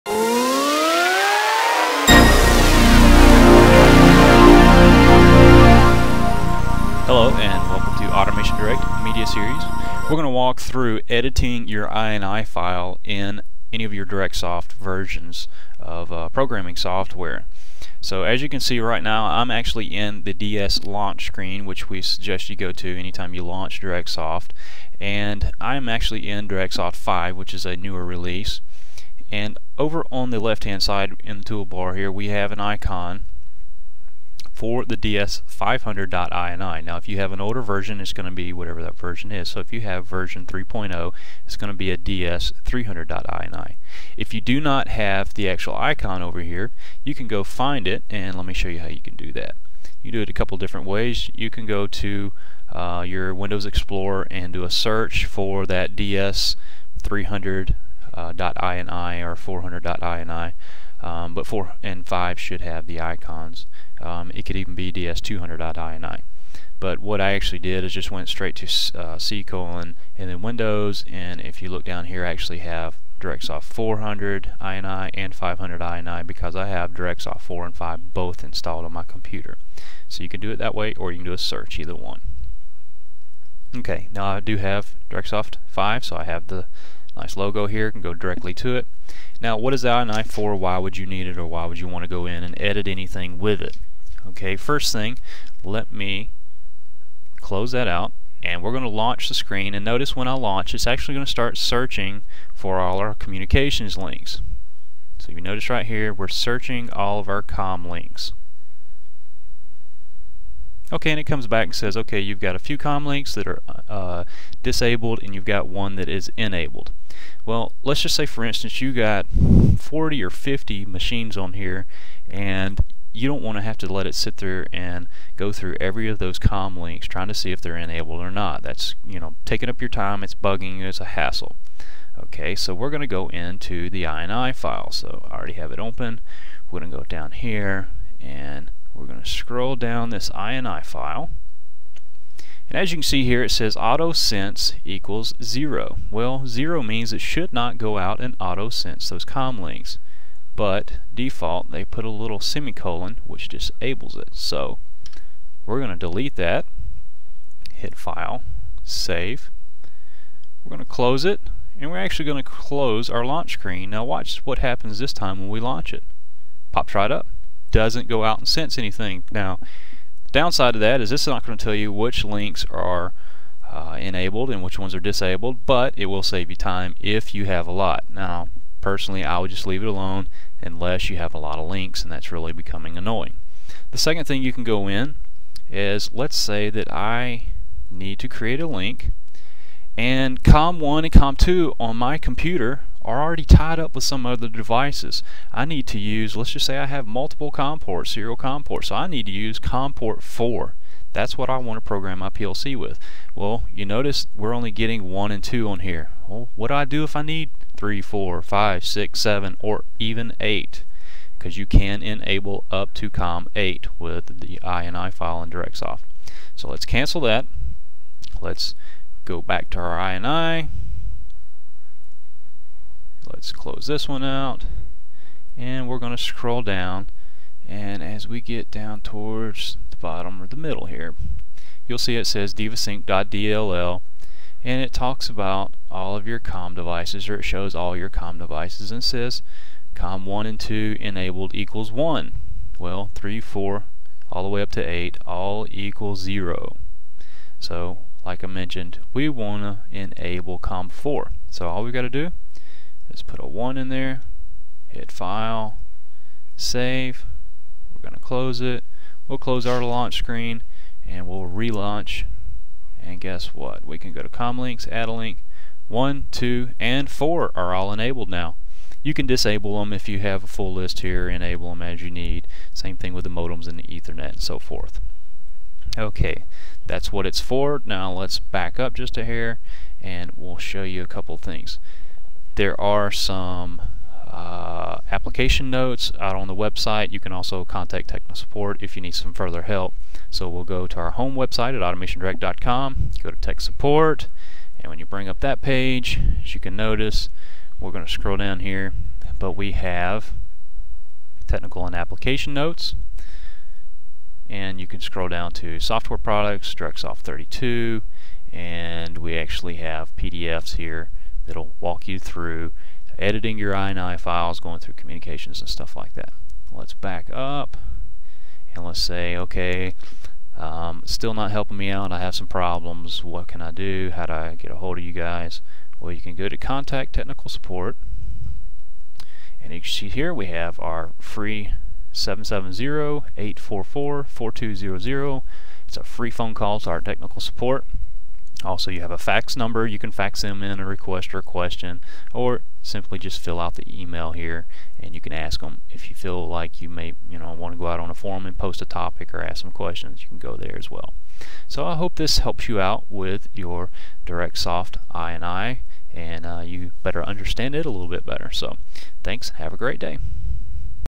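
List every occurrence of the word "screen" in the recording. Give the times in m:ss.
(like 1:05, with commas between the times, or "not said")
0:21, 1:39, 2:43, 4:20.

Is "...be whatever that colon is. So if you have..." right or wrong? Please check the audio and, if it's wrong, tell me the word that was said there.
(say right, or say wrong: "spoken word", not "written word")
wrong: "version", not "colon".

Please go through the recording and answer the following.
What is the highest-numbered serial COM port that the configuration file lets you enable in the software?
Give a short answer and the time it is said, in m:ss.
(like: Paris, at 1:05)
COM 8, at 3:33.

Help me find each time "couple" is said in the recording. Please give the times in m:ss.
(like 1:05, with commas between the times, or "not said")
0:50, 4:41.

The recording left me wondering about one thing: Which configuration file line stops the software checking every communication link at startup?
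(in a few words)
auto sense equals zero.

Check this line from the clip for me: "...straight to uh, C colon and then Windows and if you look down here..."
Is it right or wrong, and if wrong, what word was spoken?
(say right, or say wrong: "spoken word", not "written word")
right.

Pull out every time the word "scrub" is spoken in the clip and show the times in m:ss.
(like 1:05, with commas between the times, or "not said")
not said.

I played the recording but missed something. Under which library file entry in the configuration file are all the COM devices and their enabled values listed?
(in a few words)
divasync.dll.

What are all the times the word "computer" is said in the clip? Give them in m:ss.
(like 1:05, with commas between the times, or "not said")
1:19, 3:12.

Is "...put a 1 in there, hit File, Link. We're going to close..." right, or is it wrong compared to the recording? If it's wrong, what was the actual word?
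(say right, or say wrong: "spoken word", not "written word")
wrong: "Save", not "Link".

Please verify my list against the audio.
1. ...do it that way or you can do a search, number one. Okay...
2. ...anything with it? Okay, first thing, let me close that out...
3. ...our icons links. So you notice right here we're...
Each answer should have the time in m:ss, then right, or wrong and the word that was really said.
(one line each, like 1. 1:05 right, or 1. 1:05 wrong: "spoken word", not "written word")
1. 1:20 wrong: "either", not "number"
2. 1:32 right
3. 1:42 wrong: "communications", not "icons".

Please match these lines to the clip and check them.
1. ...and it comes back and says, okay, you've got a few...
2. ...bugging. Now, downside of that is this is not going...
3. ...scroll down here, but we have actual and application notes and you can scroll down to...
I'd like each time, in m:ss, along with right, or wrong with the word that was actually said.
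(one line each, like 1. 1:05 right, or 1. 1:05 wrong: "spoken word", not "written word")
1. 1:51 right
2. 2:48 wrong: "anything", not "bugging"
3. 4:58 wrong: "technical", not "actual".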